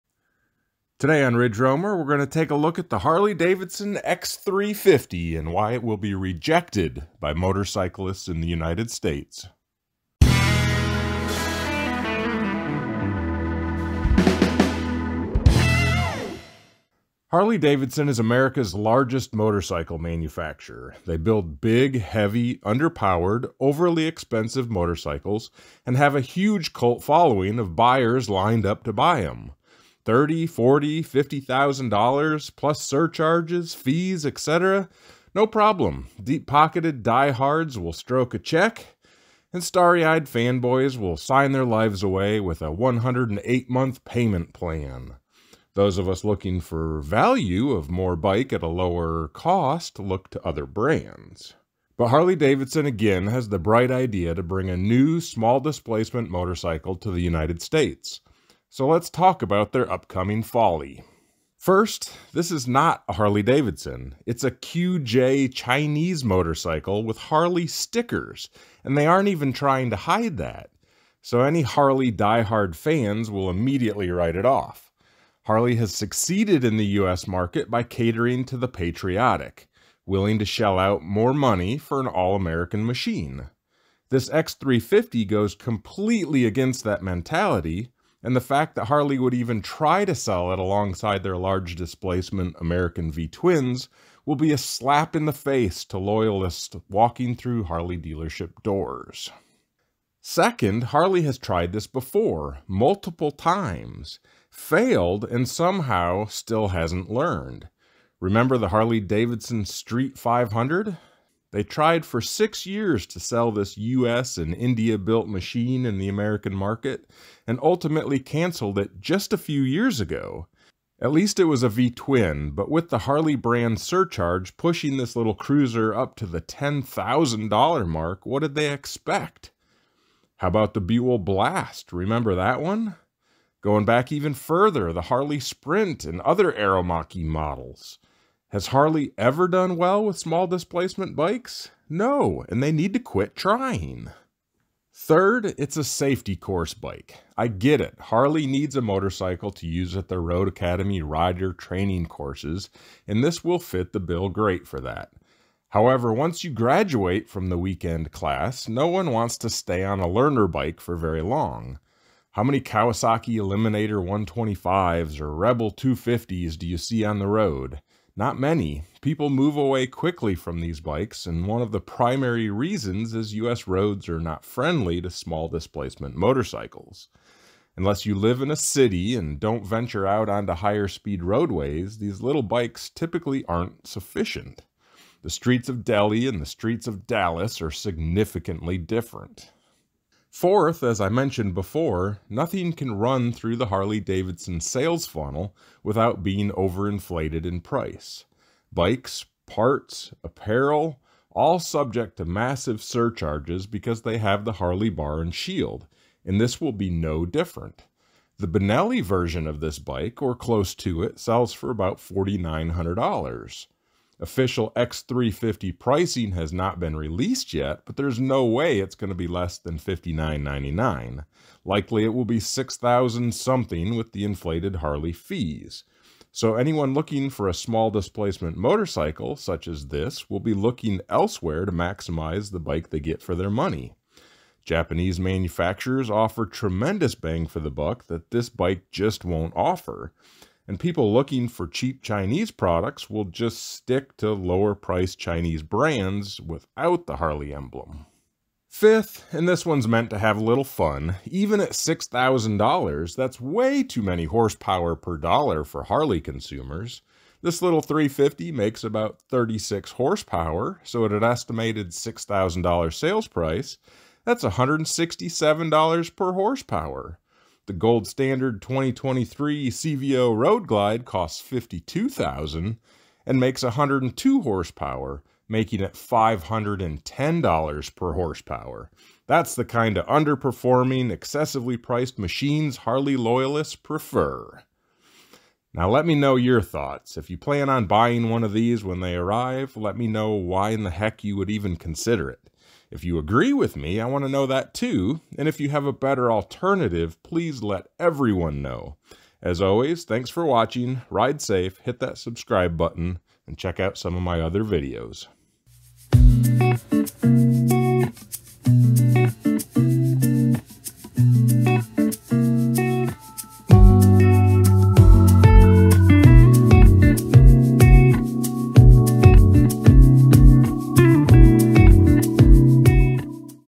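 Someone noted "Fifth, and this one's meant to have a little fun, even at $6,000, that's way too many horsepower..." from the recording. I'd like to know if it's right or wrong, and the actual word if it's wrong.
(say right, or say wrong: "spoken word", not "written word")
right.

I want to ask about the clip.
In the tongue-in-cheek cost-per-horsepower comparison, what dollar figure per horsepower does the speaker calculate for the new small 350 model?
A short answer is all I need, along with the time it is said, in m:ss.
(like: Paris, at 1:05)
$167, at 4:24.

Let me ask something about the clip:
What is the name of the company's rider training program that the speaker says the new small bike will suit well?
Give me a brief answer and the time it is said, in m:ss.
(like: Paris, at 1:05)
Road Academy, at 2:30.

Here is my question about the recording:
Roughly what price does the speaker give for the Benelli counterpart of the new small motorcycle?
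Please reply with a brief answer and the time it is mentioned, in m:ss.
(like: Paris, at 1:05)
$4,900, at 3:31.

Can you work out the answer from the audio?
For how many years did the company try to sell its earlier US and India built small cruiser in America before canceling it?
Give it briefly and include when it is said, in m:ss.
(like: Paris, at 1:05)
6 years, at 1:52.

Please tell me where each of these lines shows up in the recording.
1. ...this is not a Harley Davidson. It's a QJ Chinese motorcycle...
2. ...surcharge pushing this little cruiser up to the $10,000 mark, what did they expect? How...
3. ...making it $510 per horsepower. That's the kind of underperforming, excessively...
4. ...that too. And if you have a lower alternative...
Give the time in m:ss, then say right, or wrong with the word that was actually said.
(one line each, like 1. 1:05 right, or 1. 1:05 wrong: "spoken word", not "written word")
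1. 1:02 right
2. 2:03 right
3. 4:35 right
4. 4:54 wrong: "better", not "lower".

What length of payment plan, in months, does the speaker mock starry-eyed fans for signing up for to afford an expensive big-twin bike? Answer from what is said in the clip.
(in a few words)
108 months.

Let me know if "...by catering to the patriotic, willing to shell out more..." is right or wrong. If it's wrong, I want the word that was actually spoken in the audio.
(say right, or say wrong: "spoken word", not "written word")
right.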